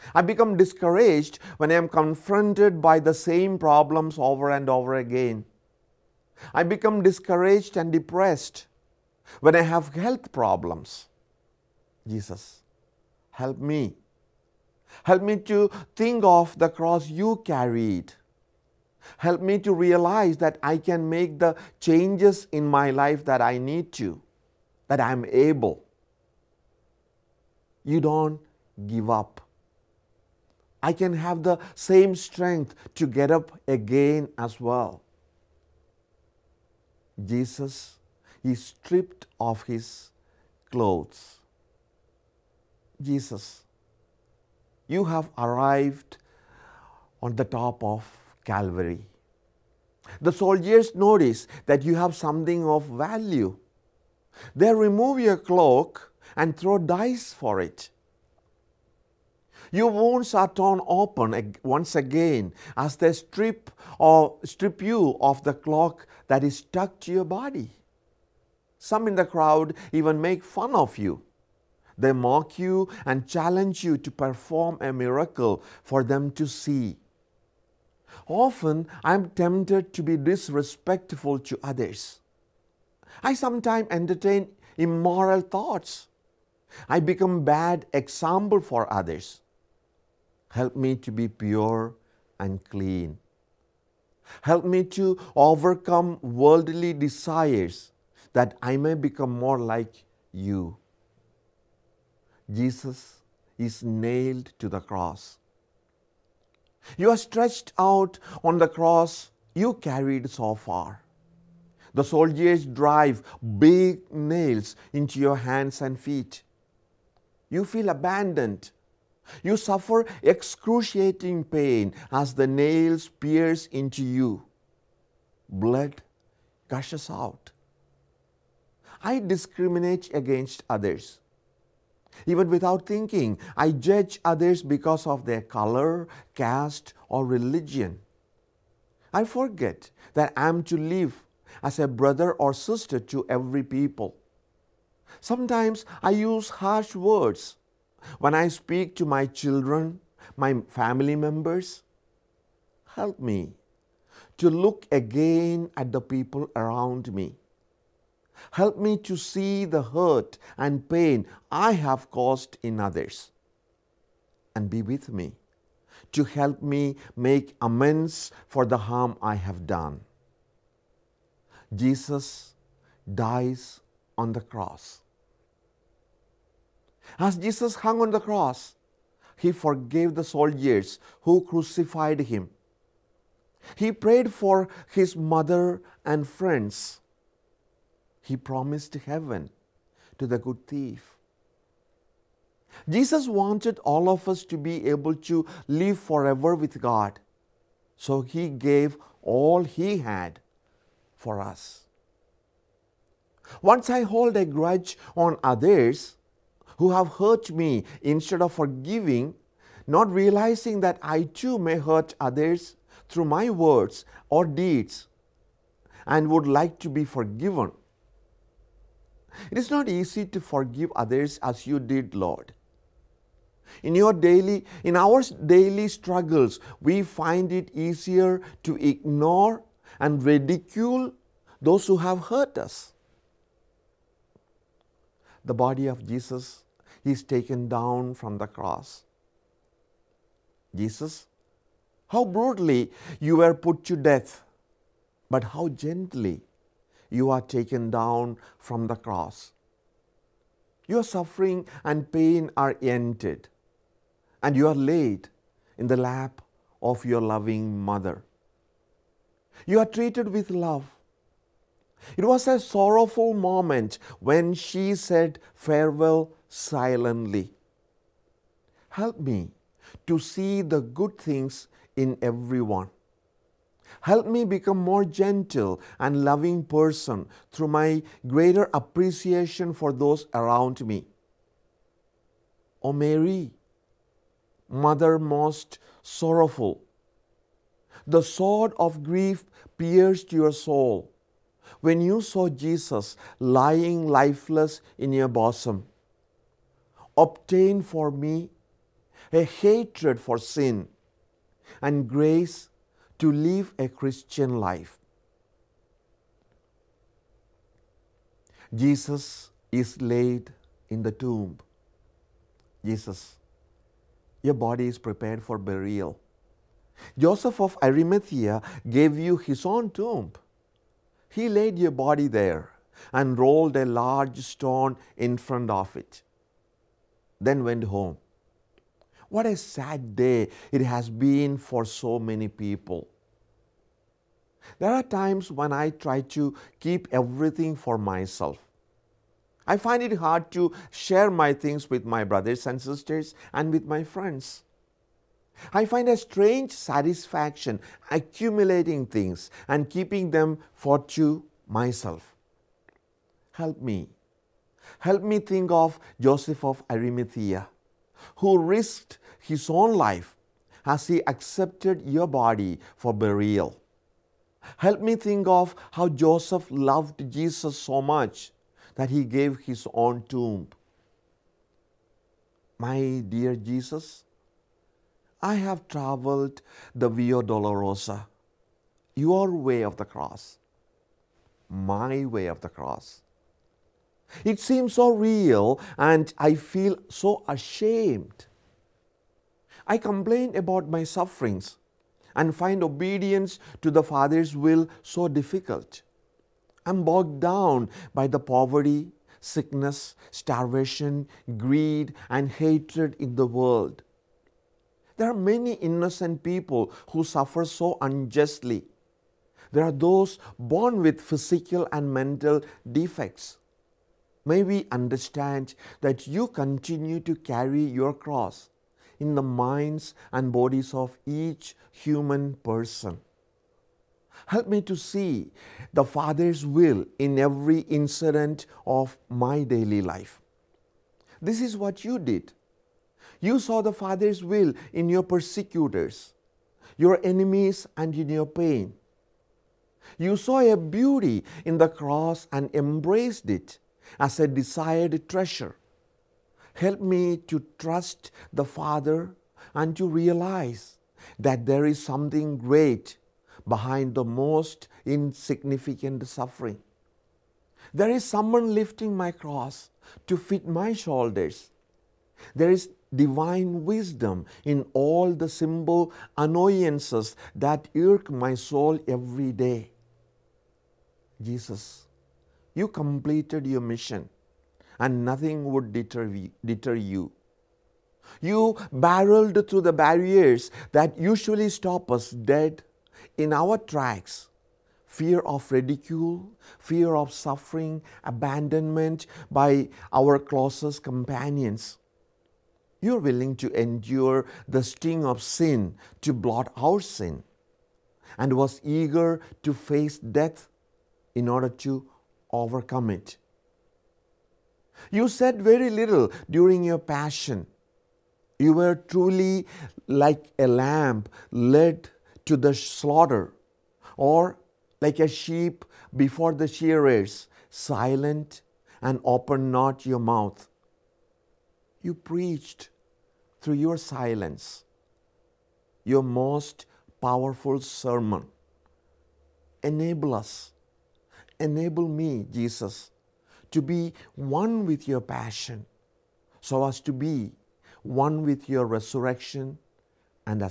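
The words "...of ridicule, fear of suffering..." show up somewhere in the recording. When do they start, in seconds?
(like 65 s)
485 s.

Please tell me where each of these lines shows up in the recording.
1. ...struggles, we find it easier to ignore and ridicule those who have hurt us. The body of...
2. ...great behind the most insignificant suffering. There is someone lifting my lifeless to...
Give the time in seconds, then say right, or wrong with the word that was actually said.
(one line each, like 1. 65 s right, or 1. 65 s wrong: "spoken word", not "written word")
1. 225 s right
2. 452 s wrong: "cross", not "lifeless".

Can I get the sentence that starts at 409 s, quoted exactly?
There are those born with physical and mental defects.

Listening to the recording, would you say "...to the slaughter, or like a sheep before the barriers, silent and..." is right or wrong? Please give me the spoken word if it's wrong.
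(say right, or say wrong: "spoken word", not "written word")
wrong: "shearers", not "barriers".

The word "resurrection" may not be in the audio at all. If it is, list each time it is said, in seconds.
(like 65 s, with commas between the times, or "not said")
538 s.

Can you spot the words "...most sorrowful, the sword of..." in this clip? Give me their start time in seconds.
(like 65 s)
285 s.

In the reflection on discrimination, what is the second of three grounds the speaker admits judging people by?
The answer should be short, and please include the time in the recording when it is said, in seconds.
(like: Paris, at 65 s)
caste, at 136 s.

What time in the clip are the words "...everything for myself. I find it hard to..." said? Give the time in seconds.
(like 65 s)
337 s.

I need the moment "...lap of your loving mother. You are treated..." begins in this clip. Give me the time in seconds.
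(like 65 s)
255 s.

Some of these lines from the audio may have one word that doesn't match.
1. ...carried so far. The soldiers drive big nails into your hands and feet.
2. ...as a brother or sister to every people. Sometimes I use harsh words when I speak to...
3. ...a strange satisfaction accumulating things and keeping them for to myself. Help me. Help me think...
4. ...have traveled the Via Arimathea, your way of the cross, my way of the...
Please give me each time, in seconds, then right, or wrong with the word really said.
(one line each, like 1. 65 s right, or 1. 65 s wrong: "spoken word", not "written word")
1. 109 s right
2. 141 s right
3. 346 s right
4. 375 s wrong: "Dolorosa", not "Arimathea".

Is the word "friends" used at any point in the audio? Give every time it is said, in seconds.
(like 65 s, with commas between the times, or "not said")
186 s, 344 s.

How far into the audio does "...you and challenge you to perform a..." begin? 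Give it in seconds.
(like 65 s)
72 s.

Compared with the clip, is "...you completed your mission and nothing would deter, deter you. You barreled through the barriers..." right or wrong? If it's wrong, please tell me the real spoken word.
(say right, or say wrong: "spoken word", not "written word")
right.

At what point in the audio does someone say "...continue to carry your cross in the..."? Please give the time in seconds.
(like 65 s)
416 s.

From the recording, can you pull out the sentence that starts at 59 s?
Your wounds are torn open once again as they strip or strip you of the cloak that is stuck to your body.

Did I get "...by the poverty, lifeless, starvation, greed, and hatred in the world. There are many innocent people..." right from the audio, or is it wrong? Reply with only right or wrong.
wrong.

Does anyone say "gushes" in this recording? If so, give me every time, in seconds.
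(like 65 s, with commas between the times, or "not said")
126 s.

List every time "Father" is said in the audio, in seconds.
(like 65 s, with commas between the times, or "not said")
394 s, 426 s, 433 s, 448 s.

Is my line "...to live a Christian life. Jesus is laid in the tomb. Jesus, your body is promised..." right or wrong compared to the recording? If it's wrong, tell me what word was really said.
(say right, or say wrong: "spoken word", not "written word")
wrong: "prepared", not "promised".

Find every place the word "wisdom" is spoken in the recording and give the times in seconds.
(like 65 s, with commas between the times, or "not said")
463 s.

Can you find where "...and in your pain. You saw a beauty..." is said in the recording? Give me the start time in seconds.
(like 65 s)
437 s.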